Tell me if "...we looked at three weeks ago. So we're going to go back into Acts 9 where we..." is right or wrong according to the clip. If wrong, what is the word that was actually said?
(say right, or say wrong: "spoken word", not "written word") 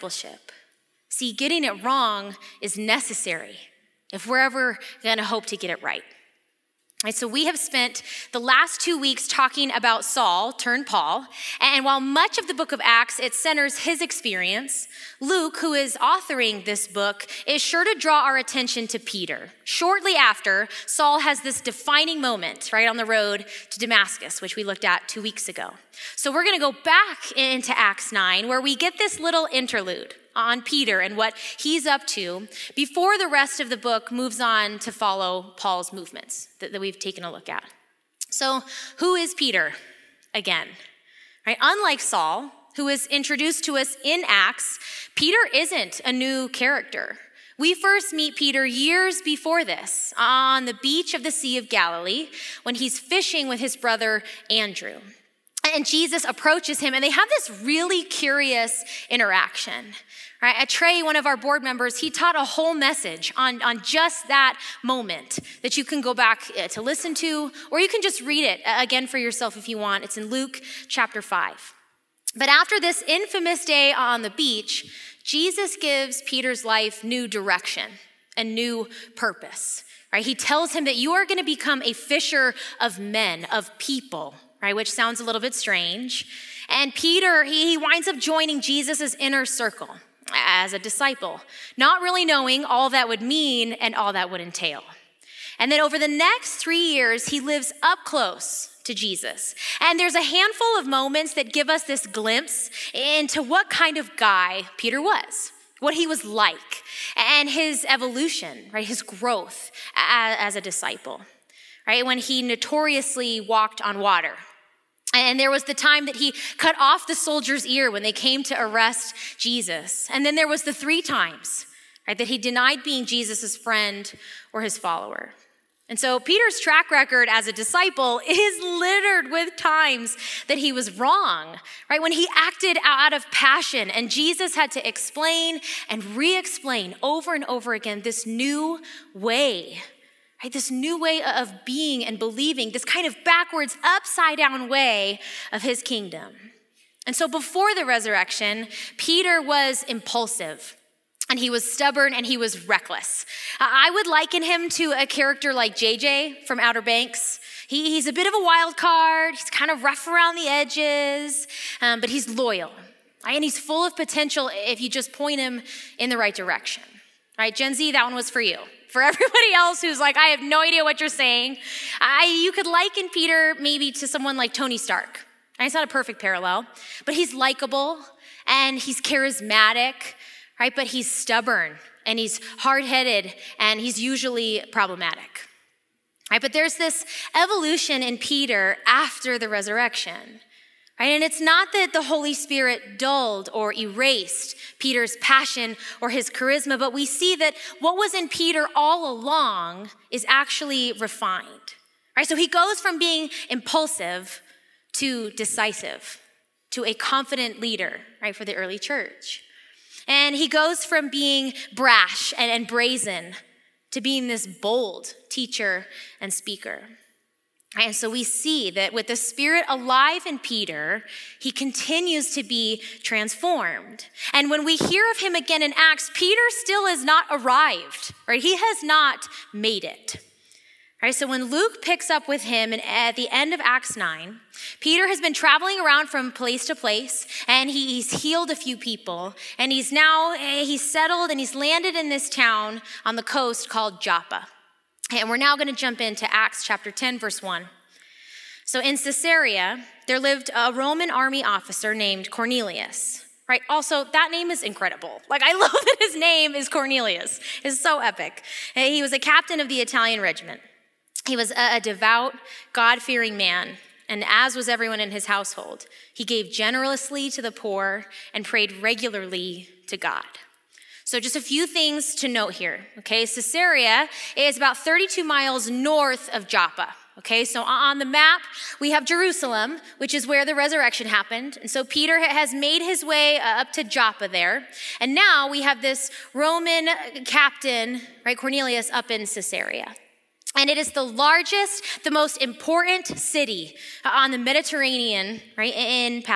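wrong: "two", not "three".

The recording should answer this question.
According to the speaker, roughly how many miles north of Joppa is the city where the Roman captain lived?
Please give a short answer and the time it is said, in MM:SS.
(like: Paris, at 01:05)
32 miles, at 04:34.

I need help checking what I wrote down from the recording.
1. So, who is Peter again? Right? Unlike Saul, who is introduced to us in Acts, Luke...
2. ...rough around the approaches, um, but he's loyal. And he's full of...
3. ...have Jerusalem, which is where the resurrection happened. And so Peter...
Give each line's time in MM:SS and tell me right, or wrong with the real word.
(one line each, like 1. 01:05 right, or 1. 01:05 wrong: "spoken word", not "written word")
1. 00:38 wrong: "Peter", not "Luke"
2. 02:39 wrong: "edges", not "approaches"
3. 04:38 right.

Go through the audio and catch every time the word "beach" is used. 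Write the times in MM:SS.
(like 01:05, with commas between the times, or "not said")
00:50, 01:14.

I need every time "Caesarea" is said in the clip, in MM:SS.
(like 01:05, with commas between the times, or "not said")
04:08, 04:33, 04:49.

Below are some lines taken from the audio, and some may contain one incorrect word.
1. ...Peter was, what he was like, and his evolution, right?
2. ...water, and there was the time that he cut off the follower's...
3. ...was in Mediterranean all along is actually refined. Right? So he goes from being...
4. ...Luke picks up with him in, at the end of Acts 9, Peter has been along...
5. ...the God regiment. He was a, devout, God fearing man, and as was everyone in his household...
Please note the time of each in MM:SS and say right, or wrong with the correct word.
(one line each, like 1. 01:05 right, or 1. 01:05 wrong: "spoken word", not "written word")
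1. 01:44 right
2. 01:53 wrong: "soldier", not "follower"
3. 03:17 wrong: "Peter", not "Mediterranean"
4. 03:51 wrong: "traveling", not "along"
5. 04:19 wrong: "Italian", not "God".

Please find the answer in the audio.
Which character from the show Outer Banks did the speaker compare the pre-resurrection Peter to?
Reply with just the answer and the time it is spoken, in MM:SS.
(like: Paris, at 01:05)
JJ, at 02:35.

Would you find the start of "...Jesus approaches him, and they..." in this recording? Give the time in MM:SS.
00:55.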